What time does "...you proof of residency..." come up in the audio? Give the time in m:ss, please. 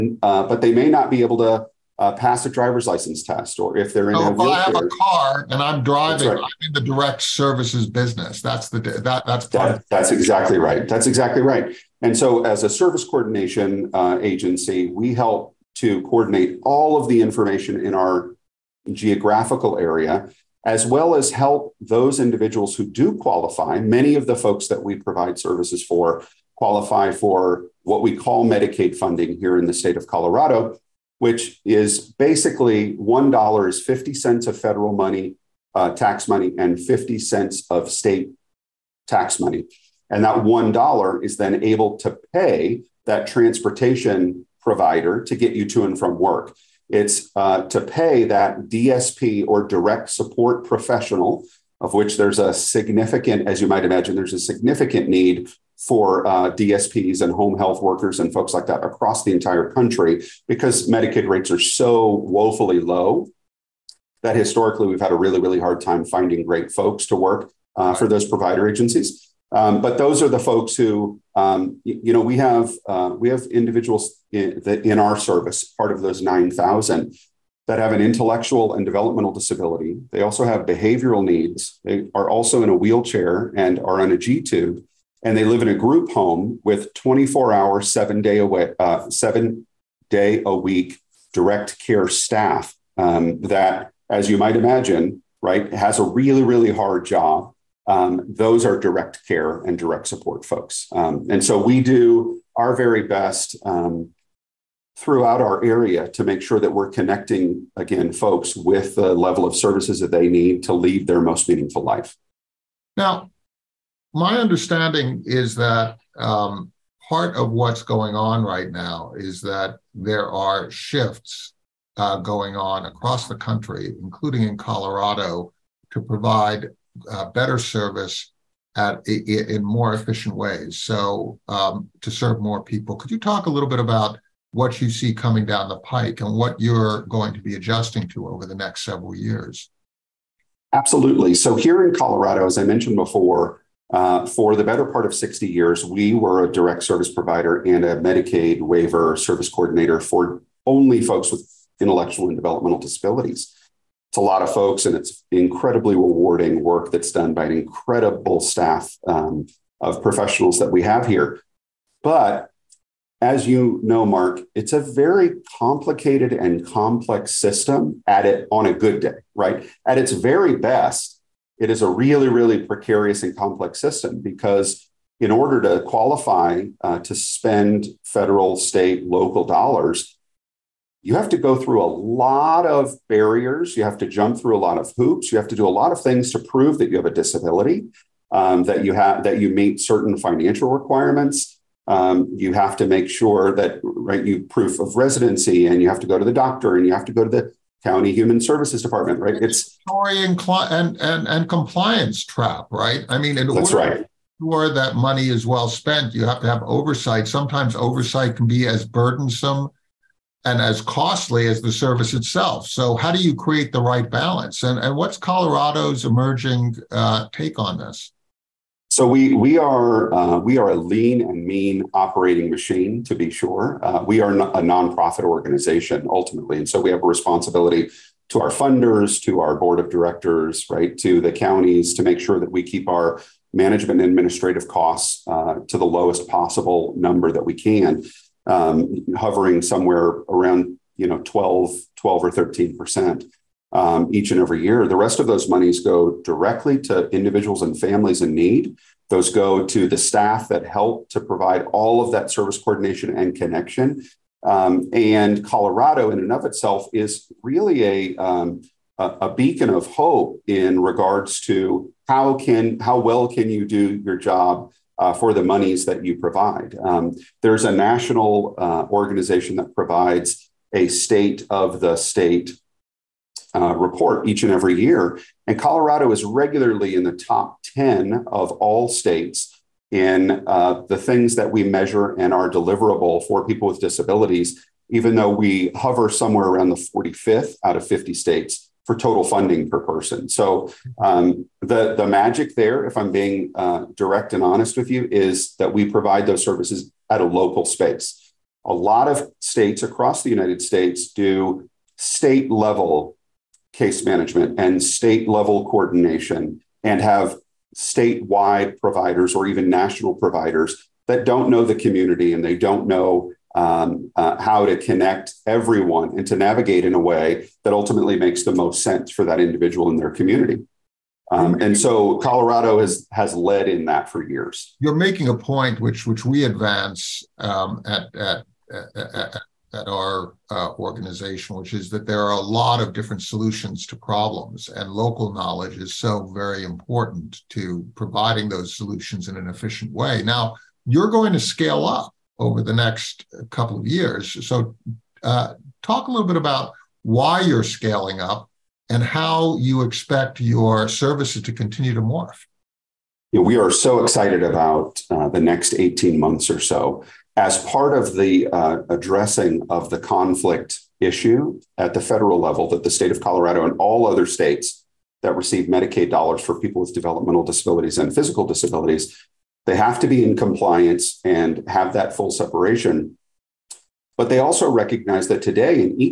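3:14.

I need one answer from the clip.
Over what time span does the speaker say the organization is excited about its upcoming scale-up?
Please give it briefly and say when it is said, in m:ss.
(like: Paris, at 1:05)
18 months, at 5:55.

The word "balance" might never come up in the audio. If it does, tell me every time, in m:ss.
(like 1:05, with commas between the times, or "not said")
3:34.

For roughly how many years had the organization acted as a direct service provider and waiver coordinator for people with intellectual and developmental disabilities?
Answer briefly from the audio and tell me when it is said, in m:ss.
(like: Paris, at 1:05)
60 years, at 2:25.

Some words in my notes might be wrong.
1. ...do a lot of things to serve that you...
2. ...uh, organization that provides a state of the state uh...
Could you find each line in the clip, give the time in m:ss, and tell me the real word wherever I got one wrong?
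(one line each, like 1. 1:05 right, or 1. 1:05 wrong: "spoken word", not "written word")
1. 3:05 wrong: "prove", not "serve"
2. 4:28 right.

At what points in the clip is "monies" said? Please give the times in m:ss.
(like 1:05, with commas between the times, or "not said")
4:05, 4:25.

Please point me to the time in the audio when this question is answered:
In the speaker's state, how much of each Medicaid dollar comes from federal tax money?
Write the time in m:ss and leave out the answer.
0:33.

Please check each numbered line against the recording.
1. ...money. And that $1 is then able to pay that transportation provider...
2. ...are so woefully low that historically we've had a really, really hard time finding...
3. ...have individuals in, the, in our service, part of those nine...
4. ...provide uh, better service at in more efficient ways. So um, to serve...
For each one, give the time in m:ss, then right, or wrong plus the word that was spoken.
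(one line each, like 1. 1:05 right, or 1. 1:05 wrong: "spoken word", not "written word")
1. 0:39 right
2. 1:01 right
3. 1:13 right
4. 2:06 right.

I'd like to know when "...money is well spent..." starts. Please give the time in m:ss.
3:24.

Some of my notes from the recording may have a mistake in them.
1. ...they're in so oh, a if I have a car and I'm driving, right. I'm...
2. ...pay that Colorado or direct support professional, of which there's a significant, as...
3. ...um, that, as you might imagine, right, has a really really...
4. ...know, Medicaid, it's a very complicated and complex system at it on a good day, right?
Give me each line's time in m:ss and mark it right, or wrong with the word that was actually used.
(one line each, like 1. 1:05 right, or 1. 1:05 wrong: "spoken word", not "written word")
1. 0:03 right
2. 0:47 wrong: "DSP", not "Colorado"
3. 1:32 right
4. 2:43 wrong: "Mark", not "Medicaid".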